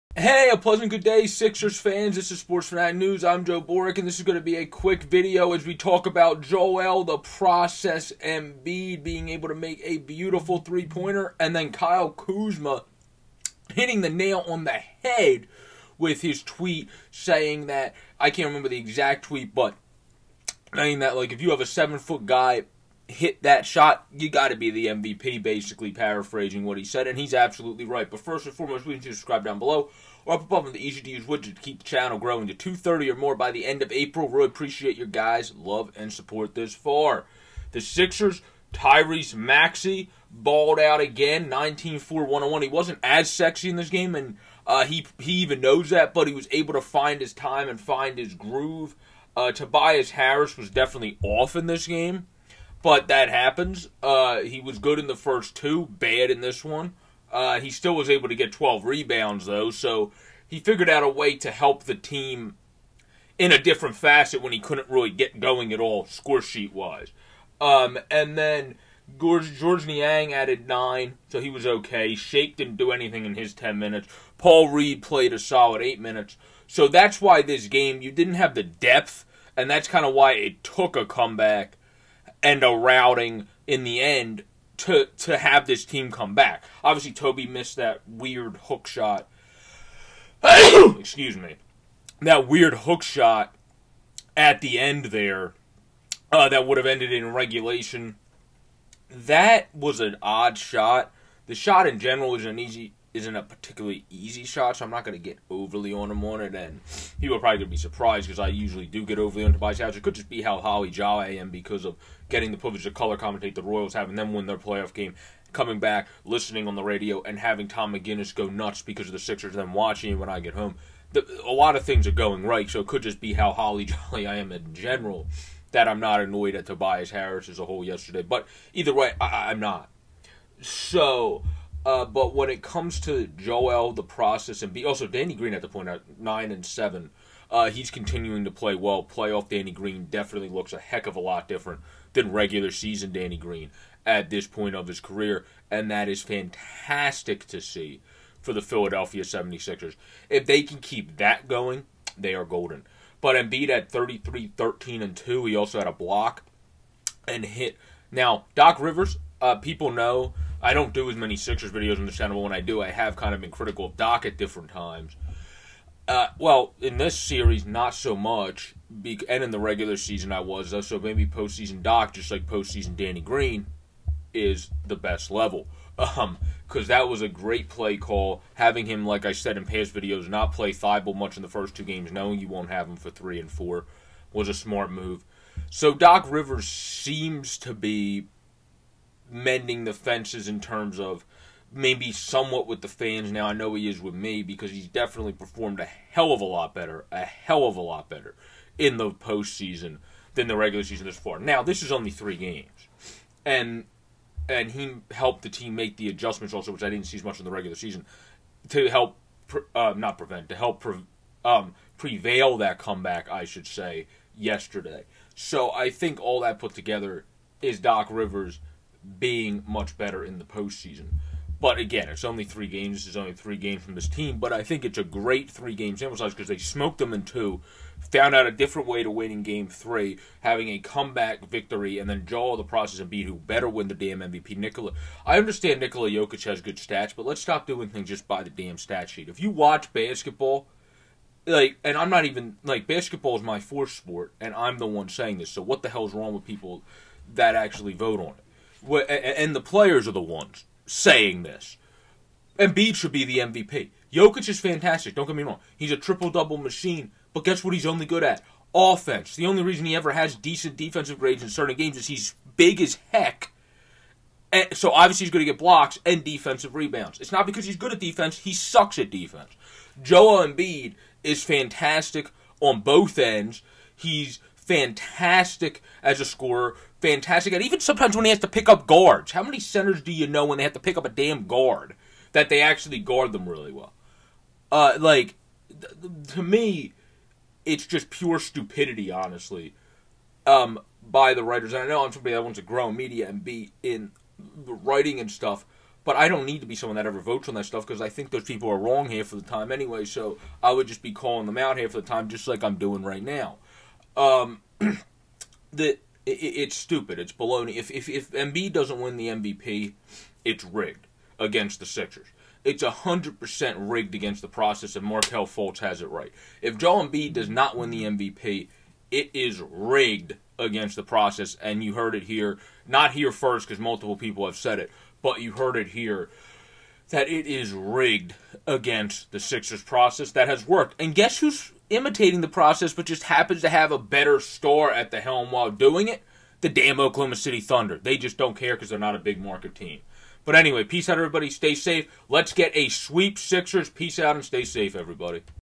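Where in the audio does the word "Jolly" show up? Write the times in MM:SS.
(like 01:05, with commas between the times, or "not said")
01:50, 02:03.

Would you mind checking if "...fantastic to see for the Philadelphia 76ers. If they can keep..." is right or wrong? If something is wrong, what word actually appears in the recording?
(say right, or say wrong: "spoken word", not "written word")
right.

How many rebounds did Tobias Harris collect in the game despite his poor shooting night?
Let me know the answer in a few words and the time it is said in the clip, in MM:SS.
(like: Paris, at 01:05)
12, at 00:58.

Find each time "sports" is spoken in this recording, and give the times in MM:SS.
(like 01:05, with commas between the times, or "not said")
00:02, 04:03.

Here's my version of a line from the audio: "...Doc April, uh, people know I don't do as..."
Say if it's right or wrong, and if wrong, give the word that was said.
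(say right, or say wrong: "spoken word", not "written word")
wrong: "Rivers", not "April".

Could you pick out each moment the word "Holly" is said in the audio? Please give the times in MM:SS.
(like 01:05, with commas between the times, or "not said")
01:50, 02:03.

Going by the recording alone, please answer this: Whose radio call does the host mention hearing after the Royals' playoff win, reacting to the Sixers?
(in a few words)
Tom McGinnis.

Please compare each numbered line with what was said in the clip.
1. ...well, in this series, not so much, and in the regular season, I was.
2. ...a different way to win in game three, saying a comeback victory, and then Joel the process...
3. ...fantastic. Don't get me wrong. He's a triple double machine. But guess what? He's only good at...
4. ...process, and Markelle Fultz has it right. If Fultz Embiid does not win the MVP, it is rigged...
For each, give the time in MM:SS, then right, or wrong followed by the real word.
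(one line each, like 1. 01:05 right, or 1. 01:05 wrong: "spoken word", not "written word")
1. 02:46 right
2. 03:48 wrong: "having", not "saying"
3. 04:14 right
4. 05:14 wrong: "Joel", not "Fultz".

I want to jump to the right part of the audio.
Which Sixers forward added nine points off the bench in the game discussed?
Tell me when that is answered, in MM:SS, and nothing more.
01:09.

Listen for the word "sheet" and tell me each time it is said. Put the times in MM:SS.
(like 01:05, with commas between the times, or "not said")
01:06, 03:59.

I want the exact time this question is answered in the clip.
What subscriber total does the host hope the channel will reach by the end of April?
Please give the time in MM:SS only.
00:32.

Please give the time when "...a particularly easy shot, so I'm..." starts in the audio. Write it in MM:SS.
01:43.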